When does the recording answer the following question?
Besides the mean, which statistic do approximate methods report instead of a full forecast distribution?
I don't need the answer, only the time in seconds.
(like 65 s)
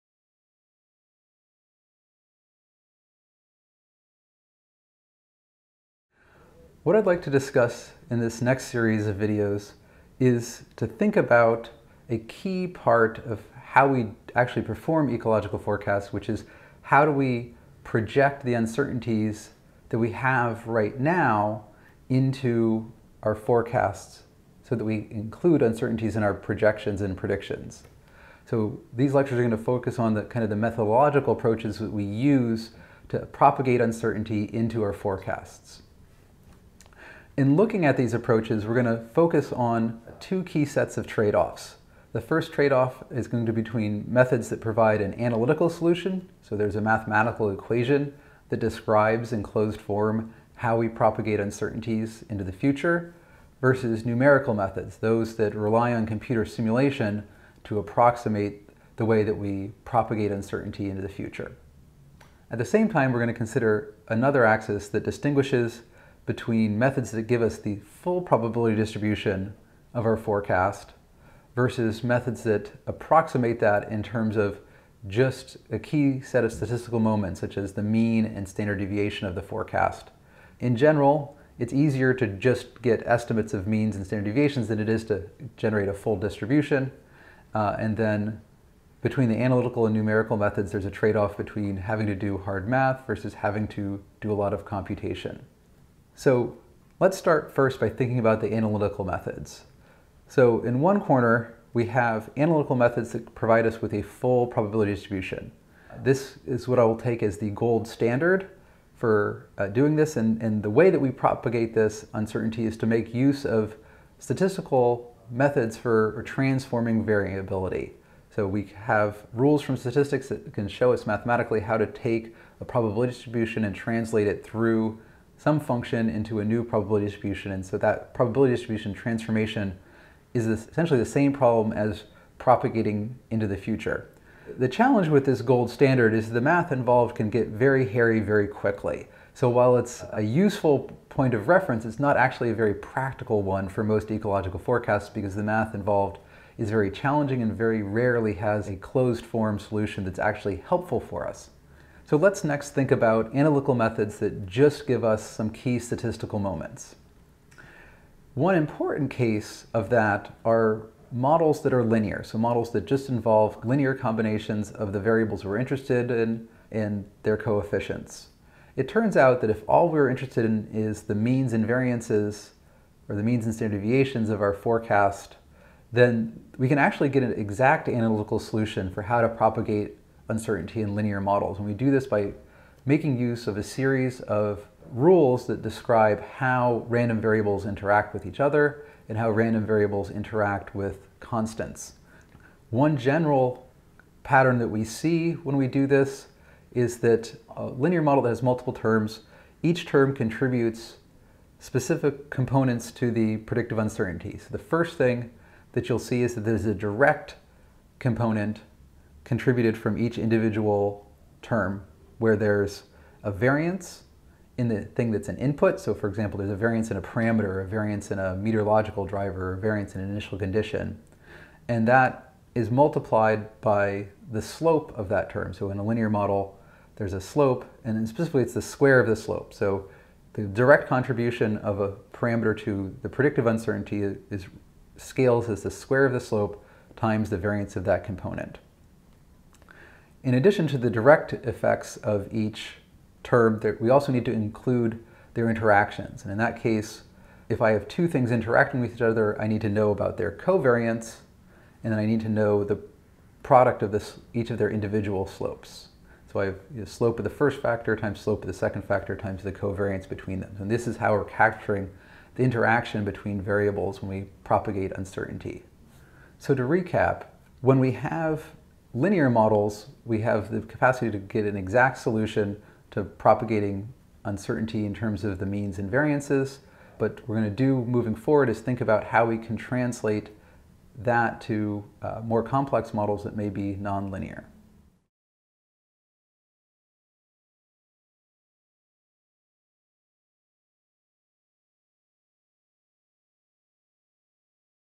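78 s.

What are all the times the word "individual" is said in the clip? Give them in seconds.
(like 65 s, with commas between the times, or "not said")
210 s, 254 s.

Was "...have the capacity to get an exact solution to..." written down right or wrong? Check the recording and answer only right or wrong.
right.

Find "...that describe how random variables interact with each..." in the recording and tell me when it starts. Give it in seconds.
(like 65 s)
185 s.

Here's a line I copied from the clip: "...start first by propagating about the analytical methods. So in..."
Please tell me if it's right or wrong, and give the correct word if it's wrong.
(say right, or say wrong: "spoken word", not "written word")
wrong: "thinking", not "propagating".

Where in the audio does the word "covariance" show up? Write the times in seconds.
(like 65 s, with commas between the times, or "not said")
250 s, 259 s.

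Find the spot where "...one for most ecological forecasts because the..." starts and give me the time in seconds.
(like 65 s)
143 s.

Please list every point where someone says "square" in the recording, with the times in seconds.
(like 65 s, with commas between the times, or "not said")
228 s, 235 s.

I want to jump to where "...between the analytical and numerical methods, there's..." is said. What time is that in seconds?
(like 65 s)
89 s.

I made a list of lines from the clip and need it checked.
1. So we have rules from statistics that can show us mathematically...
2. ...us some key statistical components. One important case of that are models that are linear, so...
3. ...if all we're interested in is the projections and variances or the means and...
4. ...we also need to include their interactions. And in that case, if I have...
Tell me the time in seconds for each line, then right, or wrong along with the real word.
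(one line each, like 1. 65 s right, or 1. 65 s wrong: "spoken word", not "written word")
1. 118 s right
2. 155 s wrong: "moments", not "components"
3. 169 s wrong: "means", not "projections"
4. 243 s right.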